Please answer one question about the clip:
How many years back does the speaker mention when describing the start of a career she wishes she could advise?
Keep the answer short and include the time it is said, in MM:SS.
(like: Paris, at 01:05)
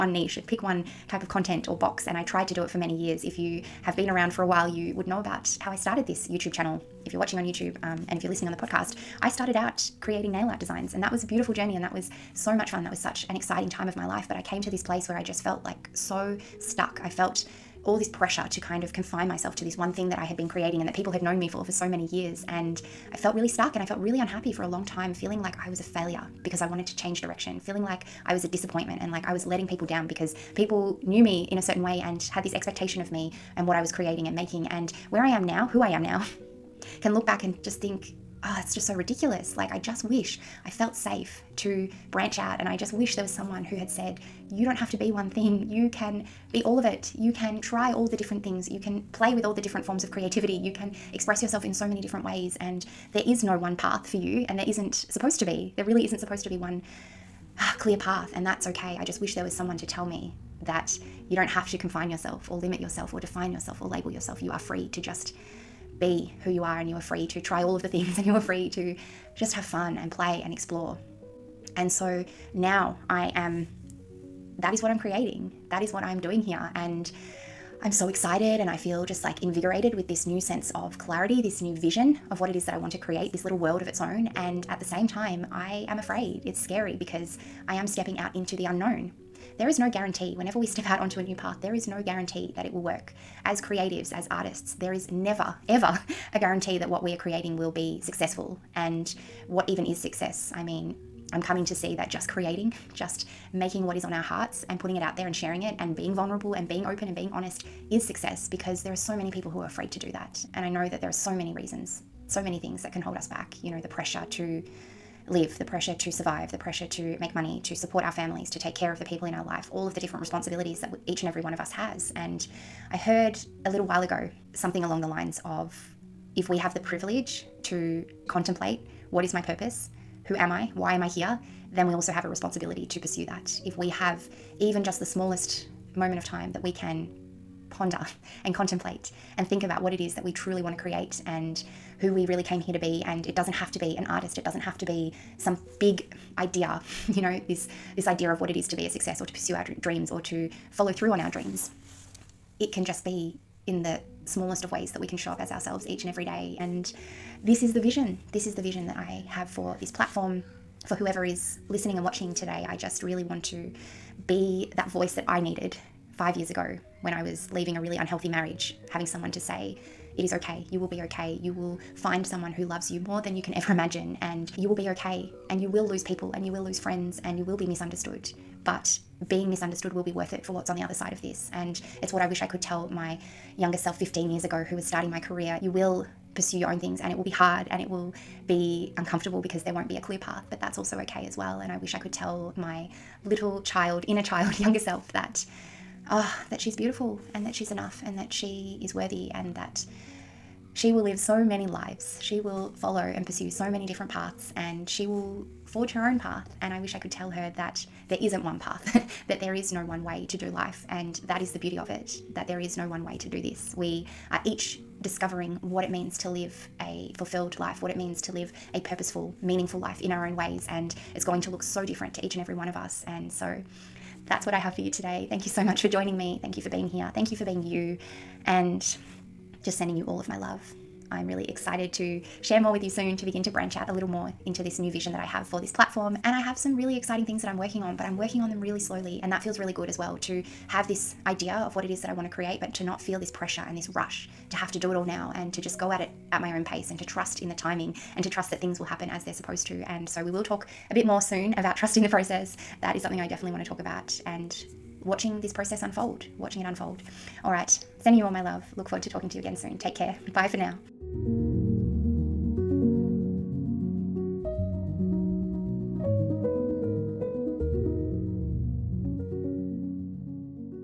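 15, at 03:03.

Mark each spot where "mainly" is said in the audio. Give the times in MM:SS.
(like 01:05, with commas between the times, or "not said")
not said.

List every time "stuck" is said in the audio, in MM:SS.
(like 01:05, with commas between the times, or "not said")
00:16, 00:23.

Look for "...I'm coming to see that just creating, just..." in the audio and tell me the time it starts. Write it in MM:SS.
01:41.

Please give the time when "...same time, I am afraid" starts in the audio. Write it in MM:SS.
01:24.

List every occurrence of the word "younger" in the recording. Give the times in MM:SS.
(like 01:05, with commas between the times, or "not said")
03:03, 03:14.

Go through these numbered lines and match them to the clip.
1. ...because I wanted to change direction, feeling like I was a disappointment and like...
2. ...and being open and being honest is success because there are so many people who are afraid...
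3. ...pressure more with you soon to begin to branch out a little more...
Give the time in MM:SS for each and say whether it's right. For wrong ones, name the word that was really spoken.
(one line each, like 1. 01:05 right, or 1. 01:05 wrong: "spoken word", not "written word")
1. 00:26 right
2. 01:46 right
3. 03:52 wrong: "share", not "pressure".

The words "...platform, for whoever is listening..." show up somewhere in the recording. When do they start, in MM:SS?
02:39.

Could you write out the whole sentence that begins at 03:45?
Thank you so much for joining me.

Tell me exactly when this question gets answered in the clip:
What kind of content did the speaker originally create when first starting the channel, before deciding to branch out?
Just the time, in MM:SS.
00:10.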